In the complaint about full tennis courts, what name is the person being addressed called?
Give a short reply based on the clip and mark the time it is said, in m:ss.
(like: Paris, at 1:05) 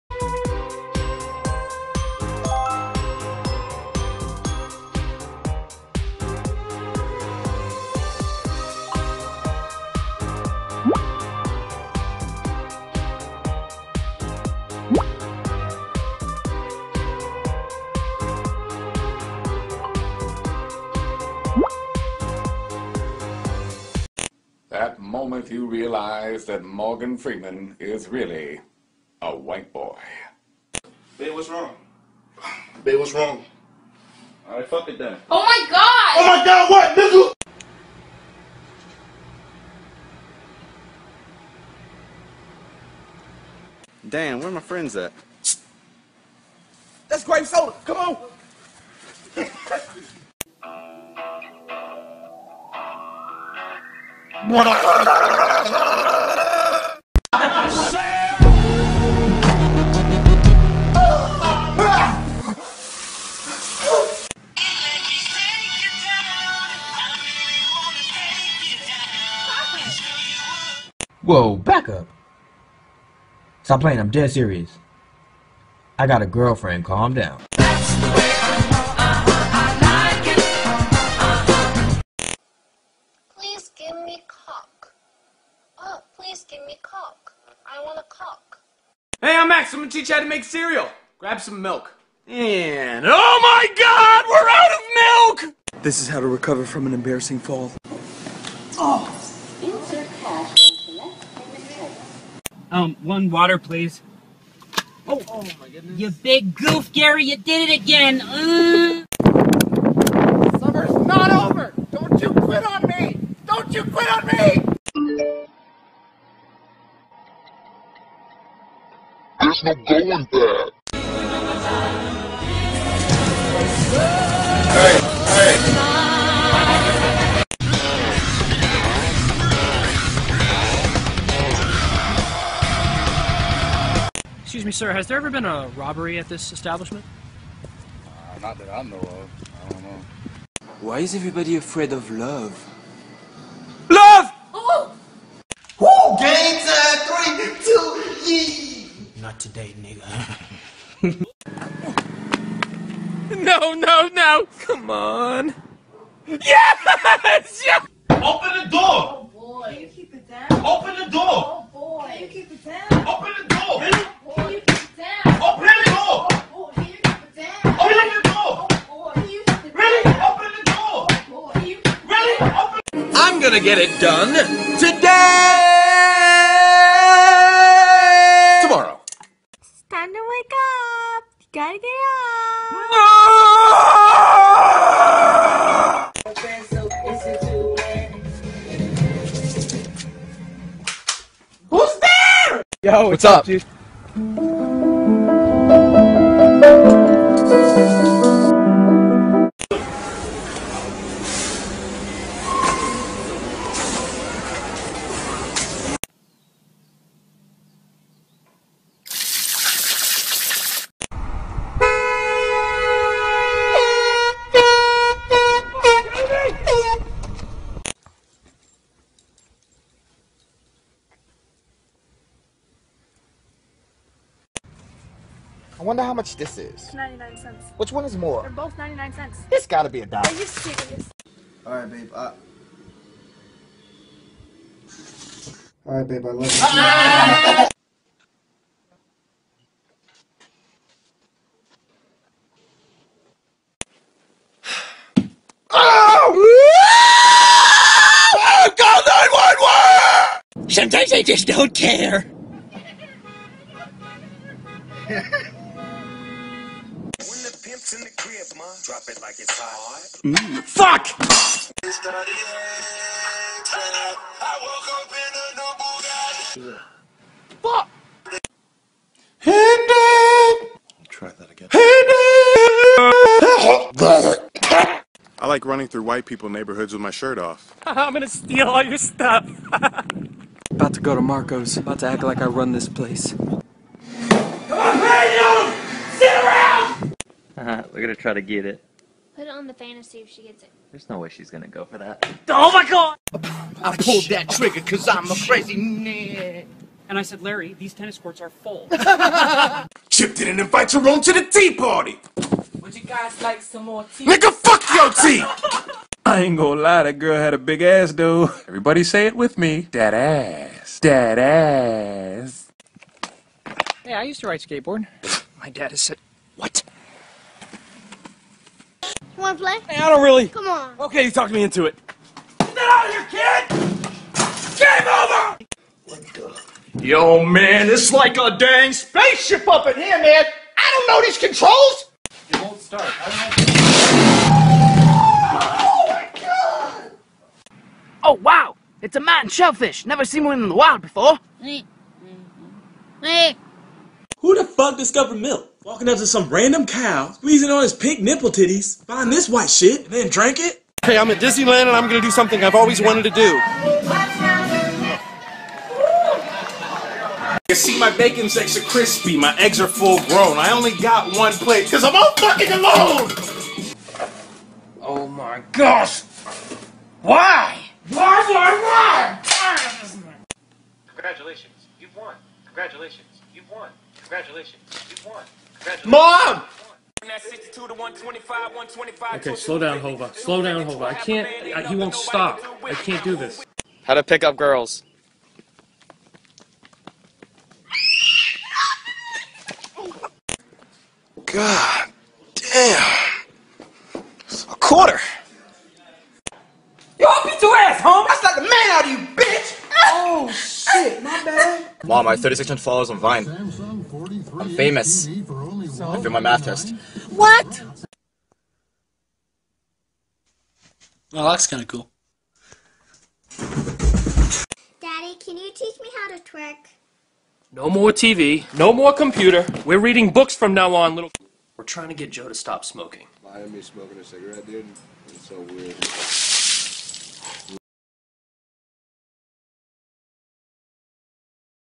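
Larry, at 4:57.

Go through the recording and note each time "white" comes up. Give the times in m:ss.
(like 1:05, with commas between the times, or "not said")
0:29, 4:36, 5:49.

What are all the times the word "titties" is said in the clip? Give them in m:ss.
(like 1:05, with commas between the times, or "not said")
5:48.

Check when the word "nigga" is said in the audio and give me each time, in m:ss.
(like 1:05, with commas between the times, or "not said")
2:29, 5:04.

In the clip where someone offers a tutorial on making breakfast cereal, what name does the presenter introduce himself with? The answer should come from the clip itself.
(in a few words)
Max.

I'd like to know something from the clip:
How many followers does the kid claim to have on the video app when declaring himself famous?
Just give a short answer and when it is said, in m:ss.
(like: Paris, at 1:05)
3,600, at 6:42.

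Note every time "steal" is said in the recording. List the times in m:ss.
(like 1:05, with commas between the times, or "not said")
4:38.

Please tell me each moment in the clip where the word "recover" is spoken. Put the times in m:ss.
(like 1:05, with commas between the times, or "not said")
1:36.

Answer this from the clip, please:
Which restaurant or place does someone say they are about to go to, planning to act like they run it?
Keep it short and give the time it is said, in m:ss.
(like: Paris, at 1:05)
Marco's, at 4:41.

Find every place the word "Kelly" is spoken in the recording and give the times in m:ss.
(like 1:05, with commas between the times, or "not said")
not said.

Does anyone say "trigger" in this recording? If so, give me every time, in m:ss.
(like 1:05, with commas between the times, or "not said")
4:54.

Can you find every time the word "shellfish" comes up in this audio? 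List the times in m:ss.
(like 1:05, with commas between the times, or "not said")
5:39.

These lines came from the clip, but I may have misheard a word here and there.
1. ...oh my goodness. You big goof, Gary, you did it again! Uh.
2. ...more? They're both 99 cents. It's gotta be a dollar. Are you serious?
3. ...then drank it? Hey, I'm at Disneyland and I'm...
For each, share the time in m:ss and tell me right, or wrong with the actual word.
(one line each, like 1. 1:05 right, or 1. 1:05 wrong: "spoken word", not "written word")
1. 1:45 right
2. 3:48 right
3. 5:50 right.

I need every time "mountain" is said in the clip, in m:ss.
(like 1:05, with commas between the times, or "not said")
5:39.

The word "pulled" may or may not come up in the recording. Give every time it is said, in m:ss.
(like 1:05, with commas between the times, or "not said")
4:53.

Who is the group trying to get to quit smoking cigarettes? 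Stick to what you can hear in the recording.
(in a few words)
Joe.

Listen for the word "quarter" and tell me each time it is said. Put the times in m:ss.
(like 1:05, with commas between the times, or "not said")
6:34.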